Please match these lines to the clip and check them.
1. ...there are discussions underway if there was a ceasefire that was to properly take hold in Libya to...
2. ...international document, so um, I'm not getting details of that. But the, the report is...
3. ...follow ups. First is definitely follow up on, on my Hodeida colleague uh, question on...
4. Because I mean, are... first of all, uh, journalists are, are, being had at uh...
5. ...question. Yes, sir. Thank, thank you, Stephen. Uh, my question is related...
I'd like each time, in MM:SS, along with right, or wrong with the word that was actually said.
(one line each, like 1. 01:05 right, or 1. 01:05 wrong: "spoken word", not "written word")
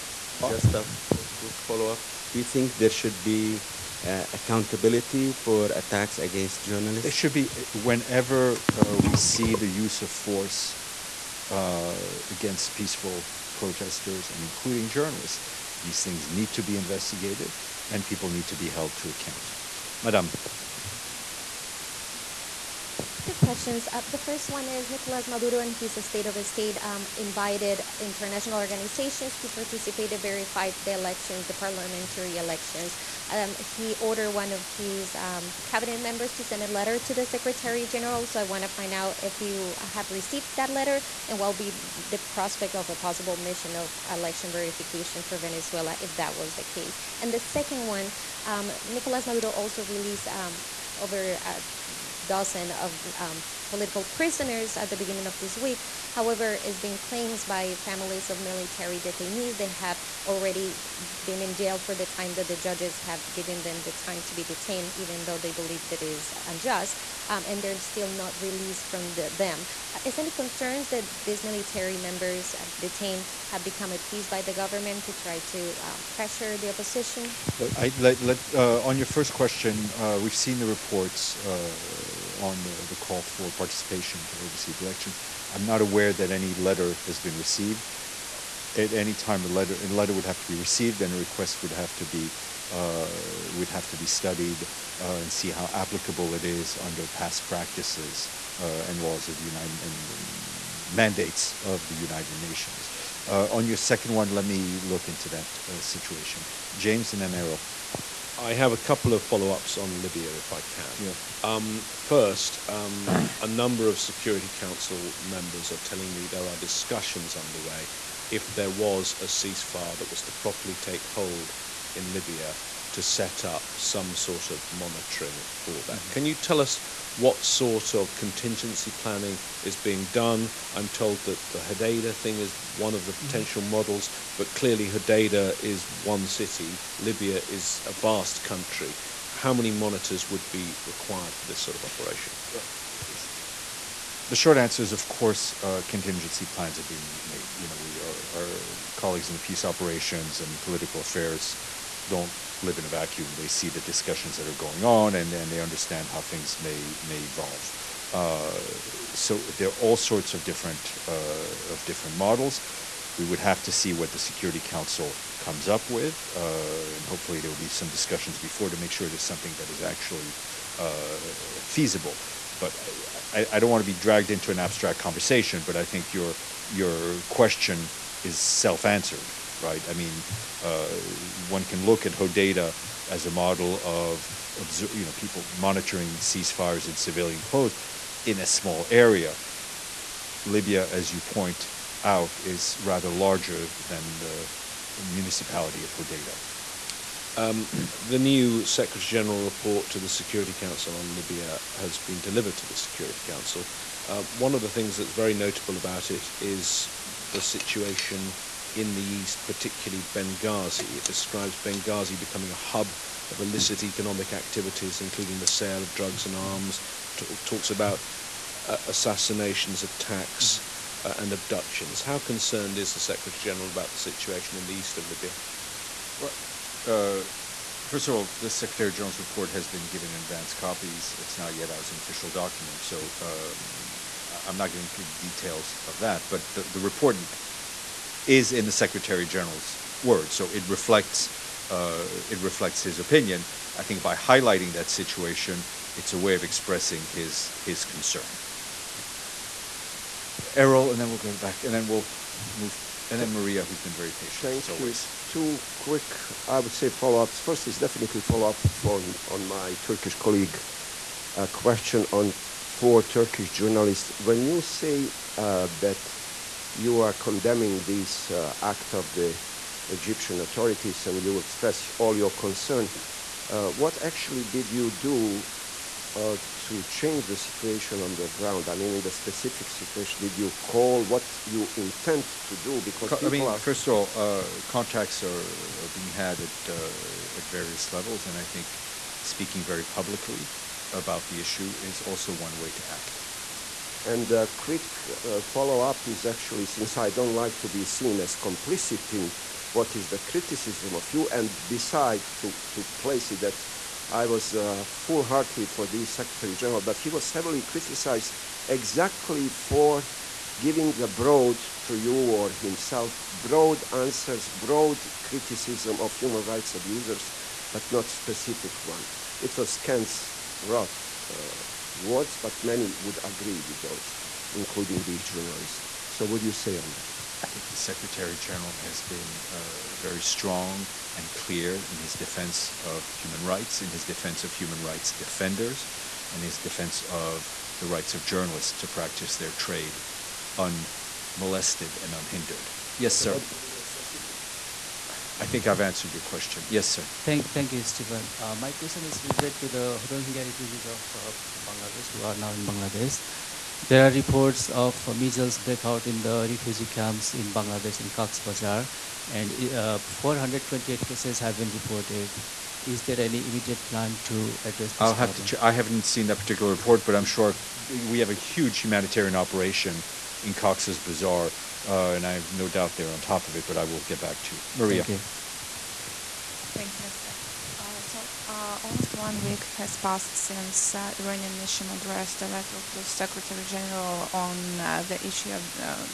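1. 01:56 right
2. 03:51 wrong: "official", not "international"
3. 04:16 wrong: "Turkish", not "Hodeida"
4. 04:42 wrong: "contacts", not "journalists"
5. 05:46 right.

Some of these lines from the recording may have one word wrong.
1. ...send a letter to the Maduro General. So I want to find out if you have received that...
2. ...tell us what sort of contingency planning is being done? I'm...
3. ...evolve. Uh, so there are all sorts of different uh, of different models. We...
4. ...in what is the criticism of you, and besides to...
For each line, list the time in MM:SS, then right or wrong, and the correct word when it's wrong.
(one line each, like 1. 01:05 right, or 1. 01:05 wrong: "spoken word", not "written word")
1. 00:36 wrong: "Secretary", not "Maduro"
2. 02:06 right
3. 02:37 right
4. 04:59 right.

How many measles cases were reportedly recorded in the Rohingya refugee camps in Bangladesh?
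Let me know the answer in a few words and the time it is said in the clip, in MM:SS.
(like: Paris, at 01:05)
428, at 06:00.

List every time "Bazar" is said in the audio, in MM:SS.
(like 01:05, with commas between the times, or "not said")
05:58, 06:11.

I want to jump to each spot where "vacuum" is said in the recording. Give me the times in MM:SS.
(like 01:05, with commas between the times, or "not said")
02:32.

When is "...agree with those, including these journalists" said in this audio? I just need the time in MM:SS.
05:23.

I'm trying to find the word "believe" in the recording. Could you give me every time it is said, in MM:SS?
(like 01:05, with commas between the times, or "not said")
01:05.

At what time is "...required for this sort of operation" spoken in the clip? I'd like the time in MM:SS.
02:20.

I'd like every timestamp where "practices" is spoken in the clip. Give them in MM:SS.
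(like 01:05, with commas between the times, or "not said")
01:37, 05:38.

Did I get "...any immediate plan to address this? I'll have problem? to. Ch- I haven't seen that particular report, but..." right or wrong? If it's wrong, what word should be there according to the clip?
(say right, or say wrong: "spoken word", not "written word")
right.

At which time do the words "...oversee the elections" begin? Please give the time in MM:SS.
01:24.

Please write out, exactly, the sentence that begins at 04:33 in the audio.
Uh, what actually did you do uh, to change the situation on the ground?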